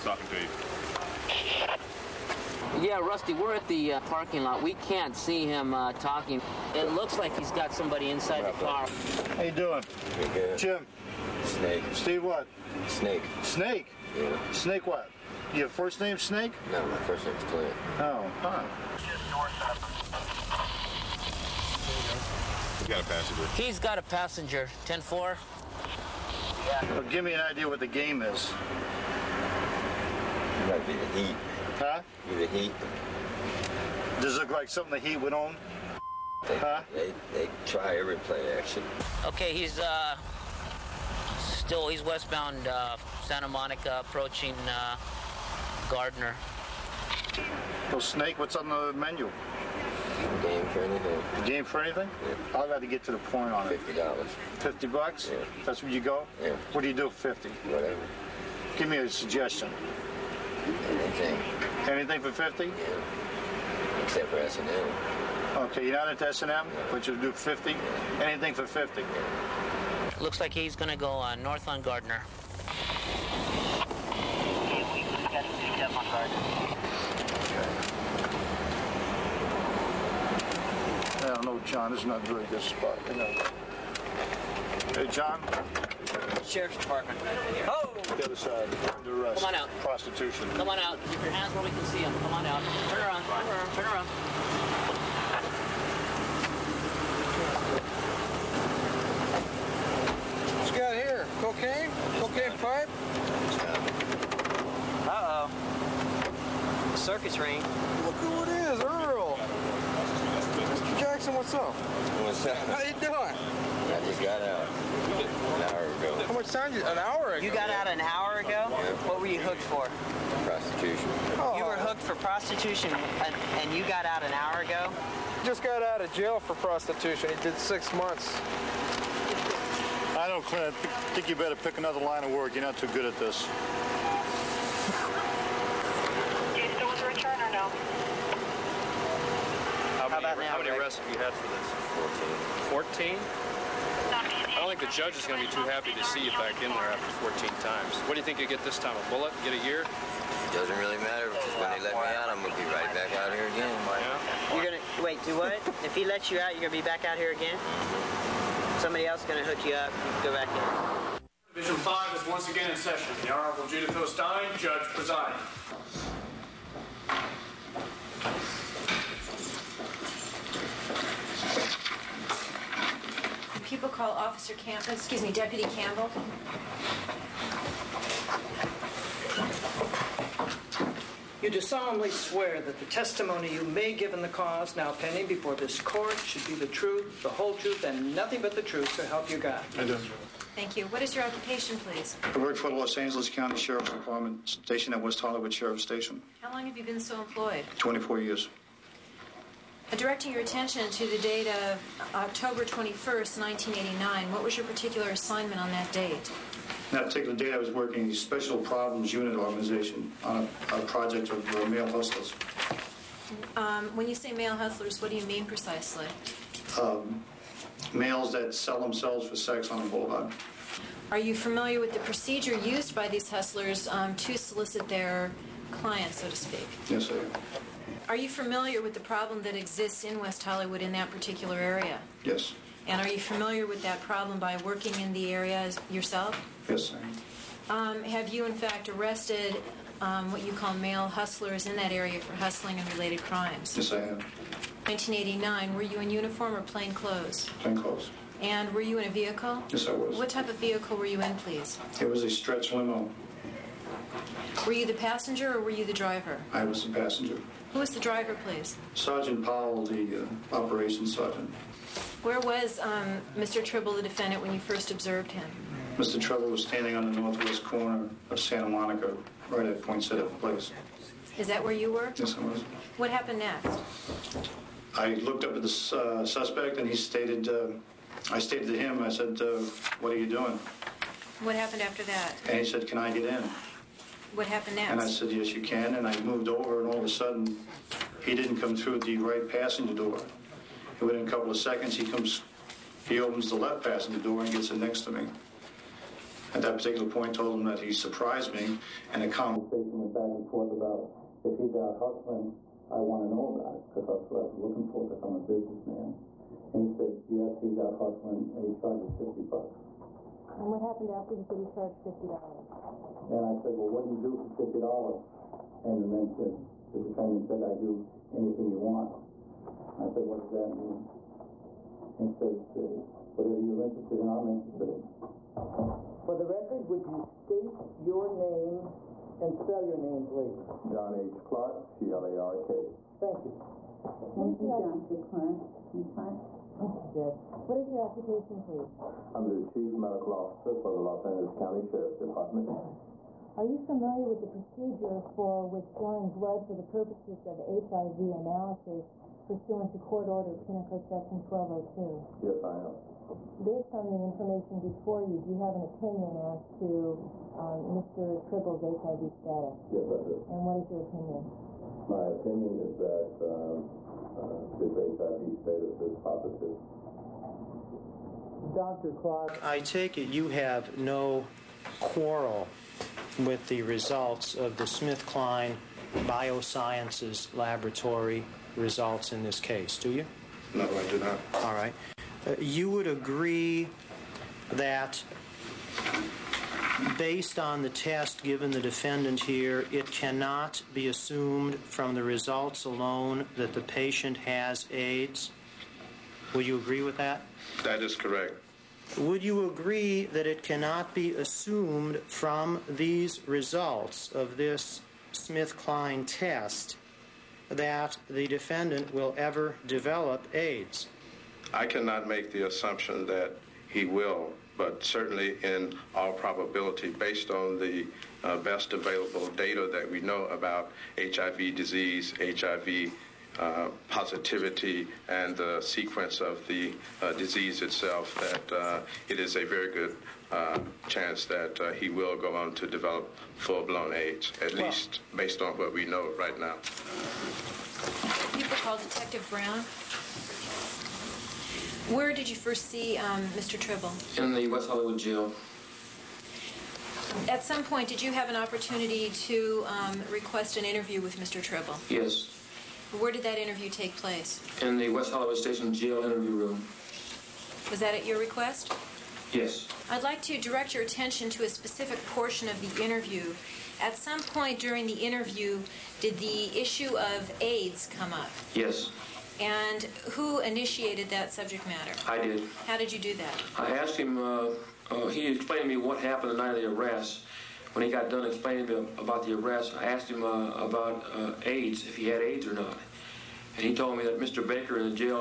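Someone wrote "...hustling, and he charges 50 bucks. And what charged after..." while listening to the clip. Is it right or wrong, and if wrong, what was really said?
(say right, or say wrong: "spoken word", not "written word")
wrong: "happened", not "charged".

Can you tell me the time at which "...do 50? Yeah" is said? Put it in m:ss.
1:07.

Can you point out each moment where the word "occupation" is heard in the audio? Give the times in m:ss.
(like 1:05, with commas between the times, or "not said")
3:11, 5:38.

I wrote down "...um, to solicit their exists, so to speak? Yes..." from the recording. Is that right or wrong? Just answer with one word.
wrong.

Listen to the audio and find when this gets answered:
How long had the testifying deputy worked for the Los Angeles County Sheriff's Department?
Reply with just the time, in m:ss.
3:17.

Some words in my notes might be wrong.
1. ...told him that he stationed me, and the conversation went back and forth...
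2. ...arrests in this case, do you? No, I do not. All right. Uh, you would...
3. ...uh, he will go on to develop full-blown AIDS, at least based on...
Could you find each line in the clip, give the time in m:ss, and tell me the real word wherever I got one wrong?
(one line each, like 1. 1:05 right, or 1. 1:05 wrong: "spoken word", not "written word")
1. 4:57 wrong: "surprised", not "stationed"
2. 6:18 wrong: "results", not "arrests"
3. 7:11 right.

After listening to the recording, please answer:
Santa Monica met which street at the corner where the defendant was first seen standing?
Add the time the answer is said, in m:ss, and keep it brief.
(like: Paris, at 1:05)
City Place, at 4:30.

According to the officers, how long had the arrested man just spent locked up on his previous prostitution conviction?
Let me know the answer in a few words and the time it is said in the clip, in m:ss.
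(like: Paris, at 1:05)
6 months, at 2:07.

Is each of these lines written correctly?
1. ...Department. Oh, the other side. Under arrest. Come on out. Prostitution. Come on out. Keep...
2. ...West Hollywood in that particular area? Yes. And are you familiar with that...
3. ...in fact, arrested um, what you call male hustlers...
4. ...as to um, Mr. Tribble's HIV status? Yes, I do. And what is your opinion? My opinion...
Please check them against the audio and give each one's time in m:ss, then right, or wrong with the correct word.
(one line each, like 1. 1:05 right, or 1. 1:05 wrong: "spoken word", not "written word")
1. 1:26 right
2. 3:50 right
3. 3:58 right
4. 5:56 right.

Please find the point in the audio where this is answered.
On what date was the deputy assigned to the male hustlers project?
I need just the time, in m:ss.
3:22.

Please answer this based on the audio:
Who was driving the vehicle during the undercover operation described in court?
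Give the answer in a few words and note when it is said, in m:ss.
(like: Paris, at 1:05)
Sergeant Powell, at 4:18.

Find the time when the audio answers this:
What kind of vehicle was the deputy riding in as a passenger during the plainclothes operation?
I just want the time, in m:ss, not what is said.
4:12.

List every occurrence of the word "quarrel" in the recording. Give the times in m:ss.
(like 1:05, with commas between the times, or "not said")
6:11.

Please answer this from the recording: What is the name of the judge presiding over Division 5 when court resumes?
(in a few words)
Judith O'Stein.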